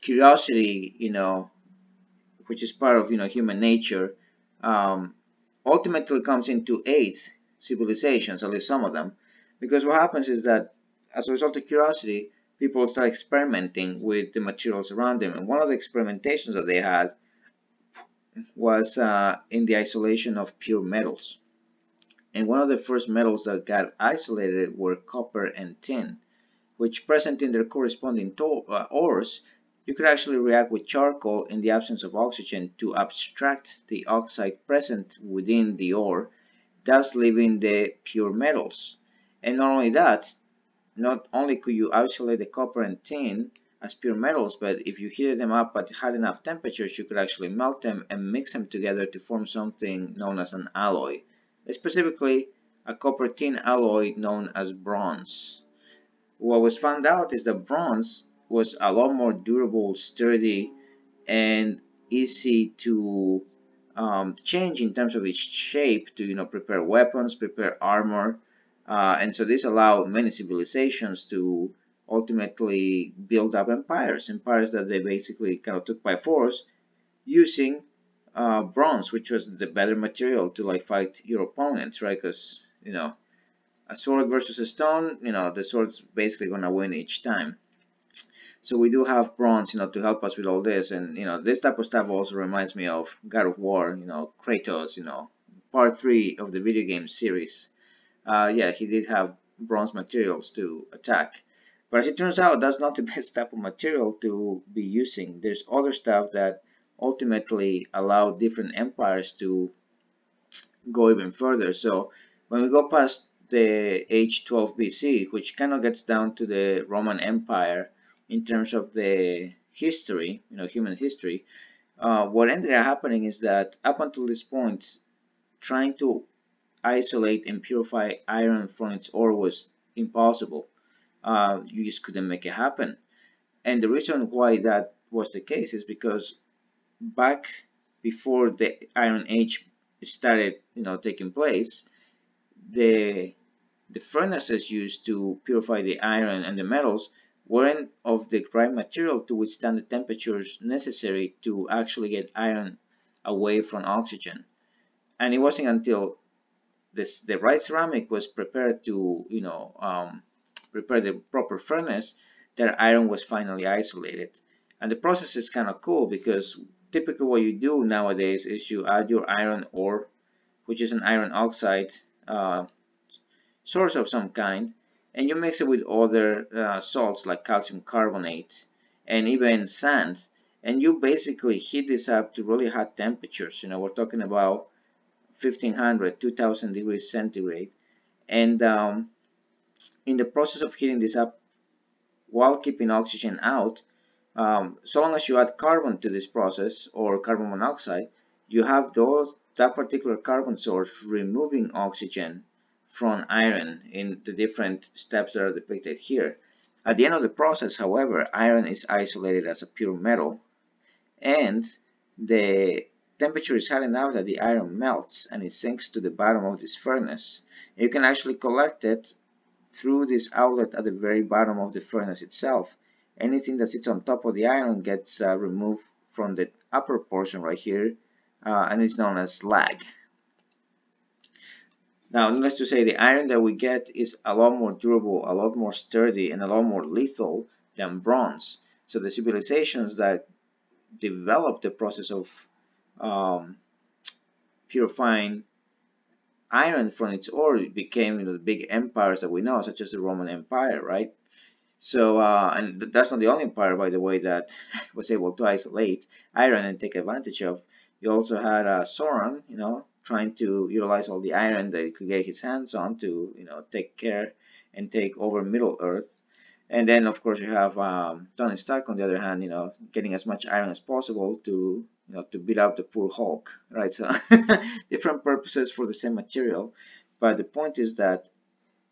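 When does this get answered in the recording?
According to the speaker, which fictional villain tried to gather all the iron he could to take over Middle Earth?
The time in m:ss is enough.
4:18.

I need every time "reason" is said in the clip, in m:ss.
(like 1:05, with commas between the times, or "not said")
2:13.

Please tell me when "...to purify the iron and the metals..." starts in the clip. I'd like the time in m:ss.
2:25.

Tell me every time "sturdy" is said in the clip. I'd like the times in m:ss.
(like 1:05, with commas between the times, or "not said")
0:59, 3:55.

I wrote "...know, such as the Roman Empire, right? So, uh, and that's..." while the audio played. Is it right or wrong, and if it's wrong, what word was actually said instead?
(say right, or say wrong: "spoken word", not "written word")
right.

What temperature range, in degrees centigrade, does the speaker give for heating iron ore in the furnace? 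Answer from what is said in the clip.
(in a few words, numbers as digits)
1500 to 2000.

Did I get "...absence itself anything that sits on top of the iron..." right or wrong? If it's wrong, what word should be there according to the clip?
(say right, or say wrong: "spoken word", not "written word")
wrong: "furnace", not "absence".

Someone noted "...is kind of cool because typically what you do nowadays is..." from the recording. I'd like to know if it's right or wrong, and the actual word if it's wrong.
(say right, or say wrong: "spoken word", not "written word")
right.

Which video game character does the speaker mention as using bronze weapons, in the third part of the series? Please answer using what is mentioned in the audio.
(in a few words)
Kratos.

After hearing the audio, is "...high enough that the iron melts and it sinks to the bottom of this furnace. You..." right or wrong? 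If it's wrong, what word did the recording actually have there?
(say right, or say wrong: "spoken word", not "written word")
right.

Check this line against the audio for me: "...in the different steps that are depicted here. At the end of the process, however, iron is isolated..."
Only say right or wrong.
right.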